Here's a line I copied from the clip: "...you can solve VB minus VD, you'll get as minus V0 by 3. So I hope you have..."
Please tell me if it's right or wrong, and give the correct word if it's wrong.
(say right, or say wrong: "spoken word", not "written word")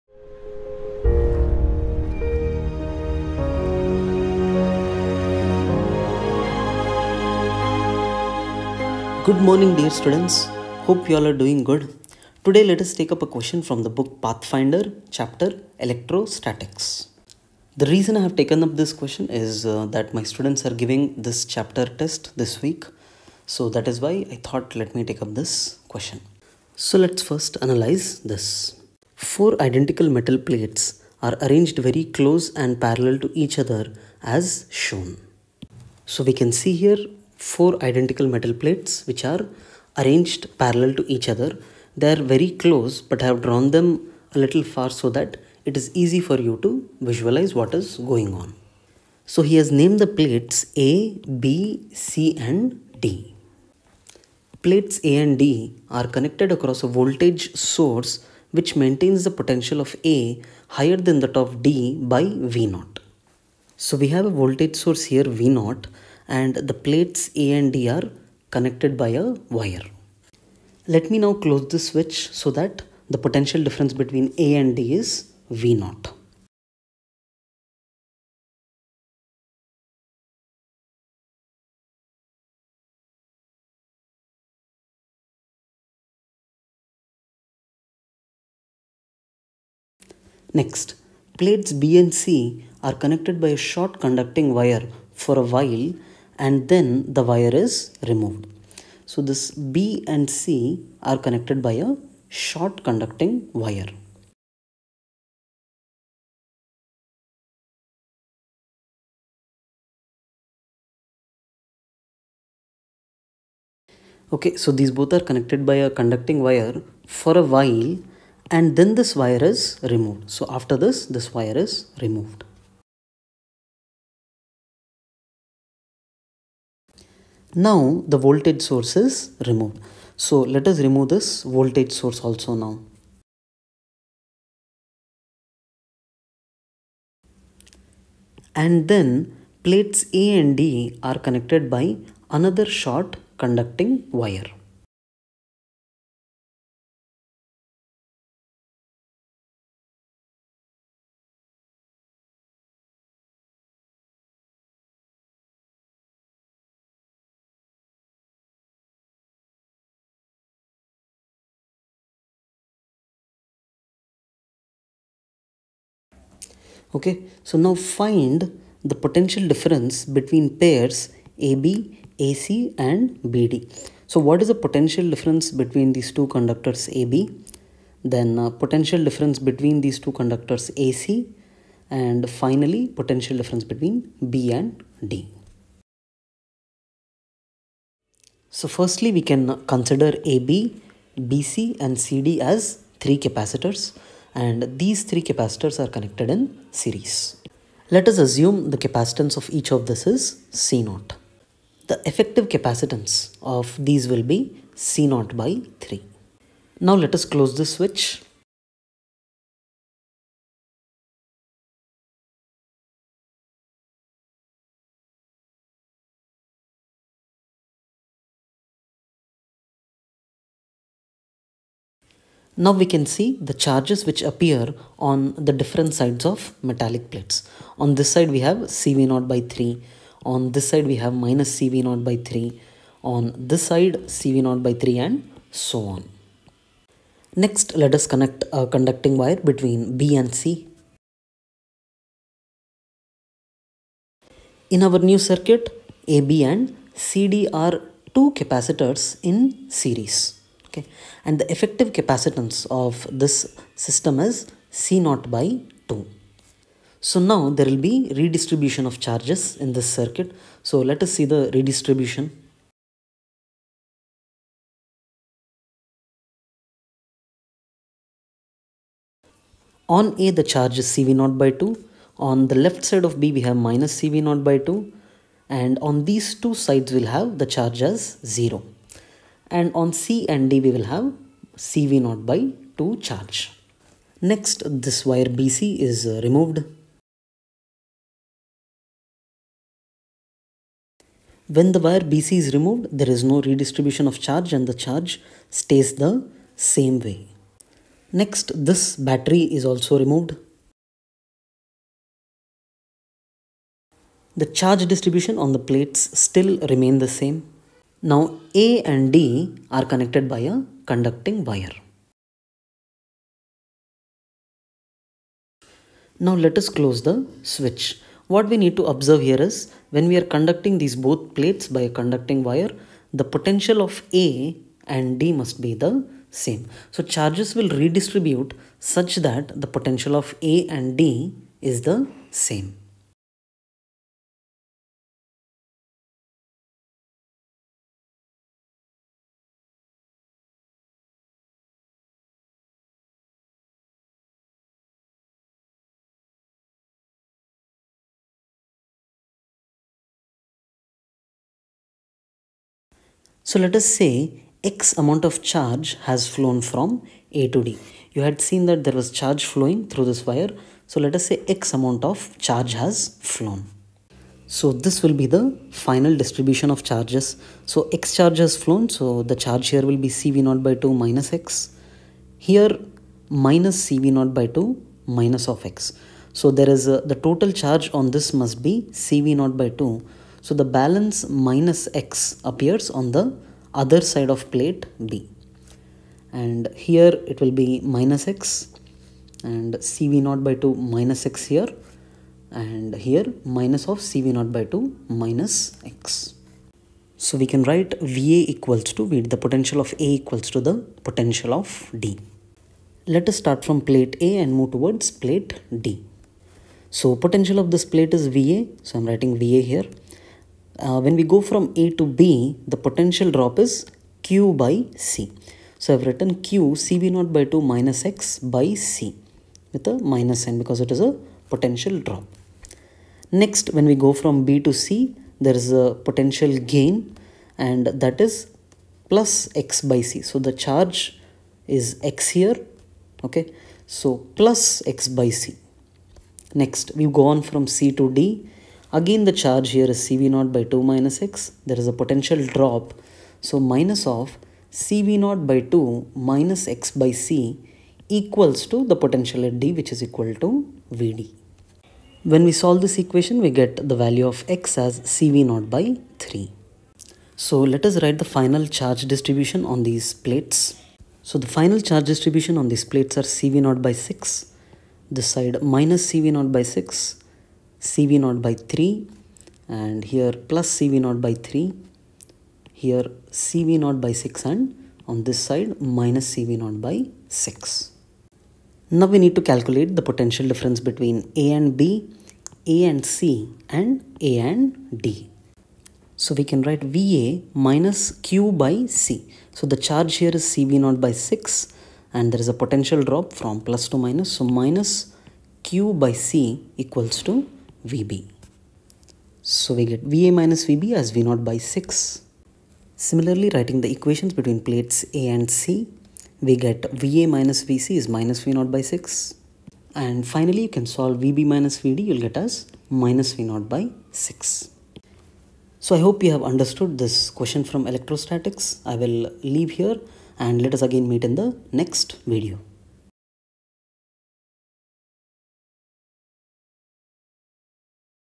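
wrong: "6", not "3".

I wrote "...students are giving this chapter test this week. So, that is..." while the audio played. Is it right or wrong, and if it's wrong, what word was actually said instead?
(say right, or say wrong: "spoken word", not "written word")
right.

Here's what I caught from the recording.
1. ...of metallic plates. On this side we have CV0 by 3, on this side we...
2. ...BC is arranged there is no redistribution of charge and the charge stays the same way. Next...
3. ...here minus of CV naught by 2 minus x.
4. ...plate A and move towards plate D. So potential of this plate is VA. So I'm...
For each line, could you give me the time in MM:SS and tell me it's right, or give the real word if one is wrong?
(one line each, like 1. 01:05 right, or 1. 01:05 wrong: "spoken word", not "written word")
1. 03:46 right
2. 04:52 wrong: "removed", not "arranged"
3. 06:32 right
4. 06:43 right.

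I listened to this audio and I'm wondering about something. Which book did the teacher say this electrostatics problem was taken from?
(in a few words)
Pathfinder.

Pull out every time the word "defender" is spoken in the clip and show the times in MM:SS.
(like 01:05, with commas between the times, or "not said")
not said.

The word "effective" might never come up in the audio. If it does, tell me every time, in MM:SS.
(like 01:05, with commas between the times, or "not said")
03:22, 04:11.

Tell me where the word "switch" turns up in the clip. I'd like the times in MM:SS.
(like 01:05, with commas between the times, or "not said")
01:11, 03:27, 05:17.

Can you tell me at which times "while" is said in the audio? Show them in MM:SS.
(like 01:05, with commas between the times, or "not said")
01:35, 01:57.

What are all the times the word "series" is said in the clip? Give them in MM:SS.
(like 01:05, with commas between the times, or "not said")
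03:16, 04:09.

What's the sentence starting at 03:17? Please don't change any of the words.
Let us assume the capacitance of each of this is C0.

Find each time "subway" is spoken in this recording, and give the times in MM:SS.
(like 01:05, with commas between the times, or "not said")
not said.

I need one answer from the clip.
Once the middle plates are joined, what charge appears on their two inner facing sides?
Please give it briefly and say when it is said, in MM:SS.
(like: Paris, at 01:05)
0, at 04:38.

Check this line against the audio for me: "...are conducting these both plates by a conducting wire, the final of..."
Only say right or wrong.
wrong.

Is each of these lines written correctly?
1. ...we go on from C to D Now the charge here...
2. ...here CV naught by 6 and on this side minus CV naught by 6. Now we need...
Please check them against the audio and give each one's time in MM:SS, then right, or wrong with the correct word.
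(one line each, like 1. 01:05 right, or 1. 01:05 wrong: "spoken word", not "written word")
1. 07:16 wrong: "Again", not "Now"
2. 07:52 right.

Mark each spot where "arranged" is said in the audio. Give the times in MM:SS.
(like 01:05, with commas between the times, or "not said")
00:31, 00:39.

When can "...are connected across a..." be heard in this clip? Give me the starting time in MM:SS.
00:55.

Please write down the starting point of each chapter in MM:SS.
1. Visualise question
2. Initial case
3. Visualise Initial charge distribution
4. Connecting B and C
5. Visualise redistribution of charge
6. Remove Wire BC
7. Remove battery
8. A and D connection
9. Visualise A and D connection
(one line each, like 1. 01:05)
1. 01:01
2. 03:00
3. 03:23
4. 03:48
5. 04:10
6. 04:35
7. 04:49
8. 04:59
9. 05:24.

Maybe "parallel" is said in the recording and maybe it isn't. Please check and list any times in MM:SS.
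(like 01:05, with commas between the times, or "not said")
00:32, 00:40.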